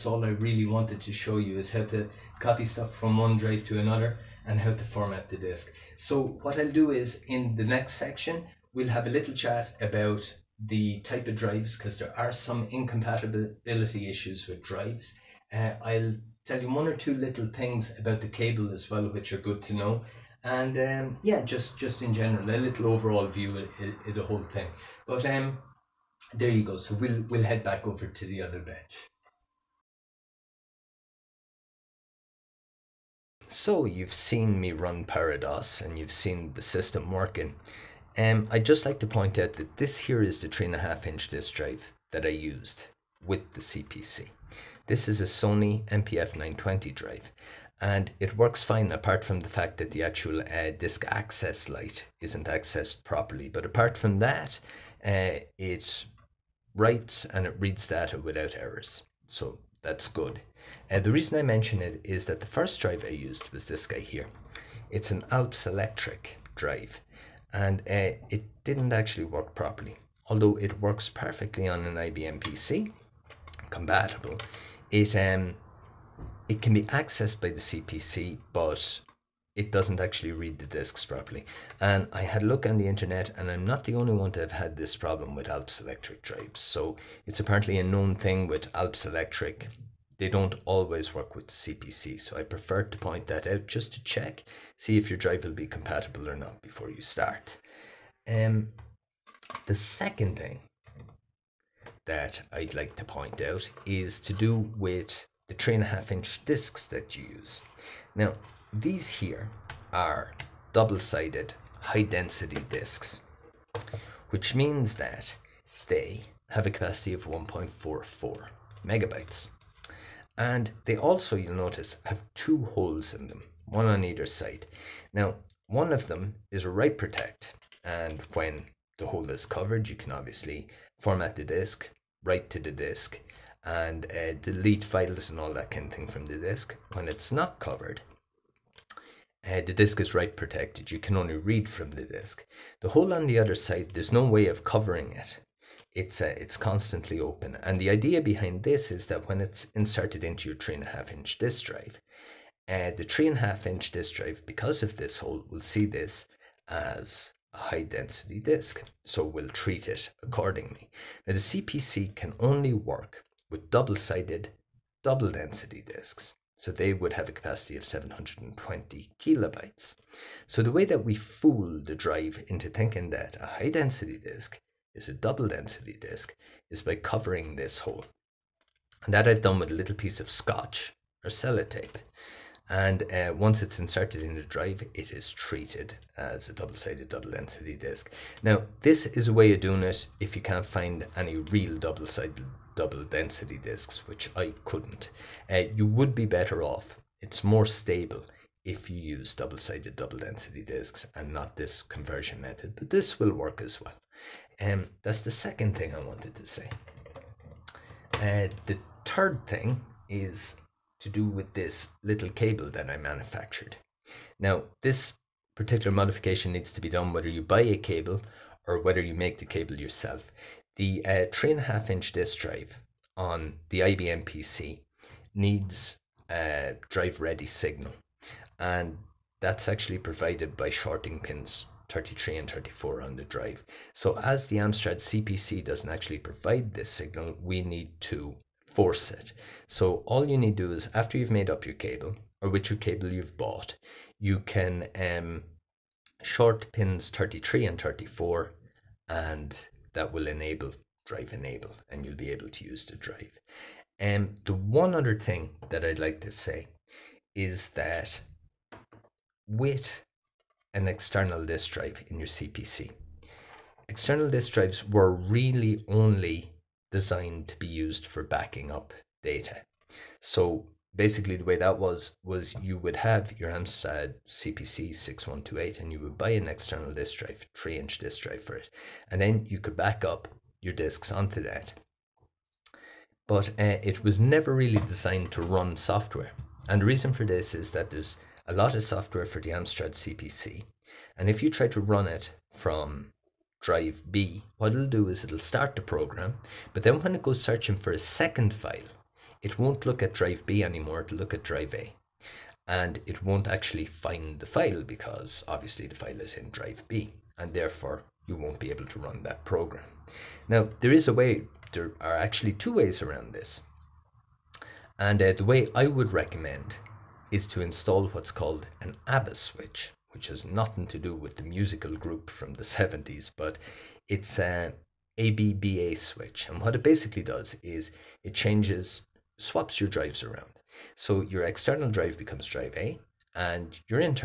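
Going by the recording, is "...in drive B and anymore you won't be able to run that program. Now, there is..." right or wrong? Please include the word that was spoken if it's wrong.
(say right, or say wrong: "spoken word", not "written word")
wrong: "therefore", not "anymore".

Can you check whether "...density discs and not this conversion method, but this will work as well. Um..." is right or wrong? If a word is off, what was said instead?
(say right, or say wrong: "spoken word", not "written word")
right.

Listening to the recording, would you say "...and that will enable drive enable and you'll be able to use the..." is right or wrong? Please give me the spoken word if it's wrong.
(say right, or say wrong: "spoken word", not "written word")
right.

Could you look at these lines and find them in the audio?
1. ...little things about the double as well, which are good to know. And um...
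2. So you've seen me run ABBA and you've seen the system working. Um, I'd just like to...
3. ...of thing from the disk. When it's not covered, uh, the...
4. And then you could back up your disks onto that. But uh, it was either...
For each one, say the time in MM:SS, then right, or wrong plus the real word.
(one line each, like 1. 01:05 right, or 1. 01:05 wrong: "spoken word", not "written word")
1. 00:17 wrong: "cable", not "double"
2. 00:33 wrong: "ParaDOS", not "ABBA"
3. 02:15 right
4. 04:39 wrong: "never", not "either".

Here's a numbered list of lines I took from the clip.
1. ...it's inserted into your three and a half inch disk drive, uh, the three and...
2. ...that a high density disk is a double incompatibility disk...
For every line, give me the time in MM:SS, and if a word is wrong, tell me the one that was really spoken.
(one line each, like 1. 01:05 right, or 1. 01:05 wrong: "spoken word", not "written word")
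1. 02:29 right
2. 02:53 wrong: "density", not "incompatibility".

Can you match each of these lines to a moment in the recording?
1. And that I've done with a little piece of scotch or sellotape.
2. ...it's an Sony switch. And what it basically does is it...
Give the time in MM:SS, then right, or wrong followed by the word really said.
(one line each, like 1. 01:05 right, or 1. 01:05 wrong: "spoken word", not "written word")
1. 02:59 right
2. 05:24 wrong: "ABBA", not "Sony".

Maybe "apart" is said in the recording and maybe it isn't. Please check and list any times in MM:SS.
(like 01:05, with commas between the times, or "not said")
00:48, 00:53.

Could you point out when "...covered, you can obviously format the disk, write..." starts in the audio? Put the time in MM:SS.
02:09.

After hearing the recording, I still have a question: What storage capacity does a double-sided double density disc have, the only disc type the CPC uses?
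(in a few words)
720 kilobytes.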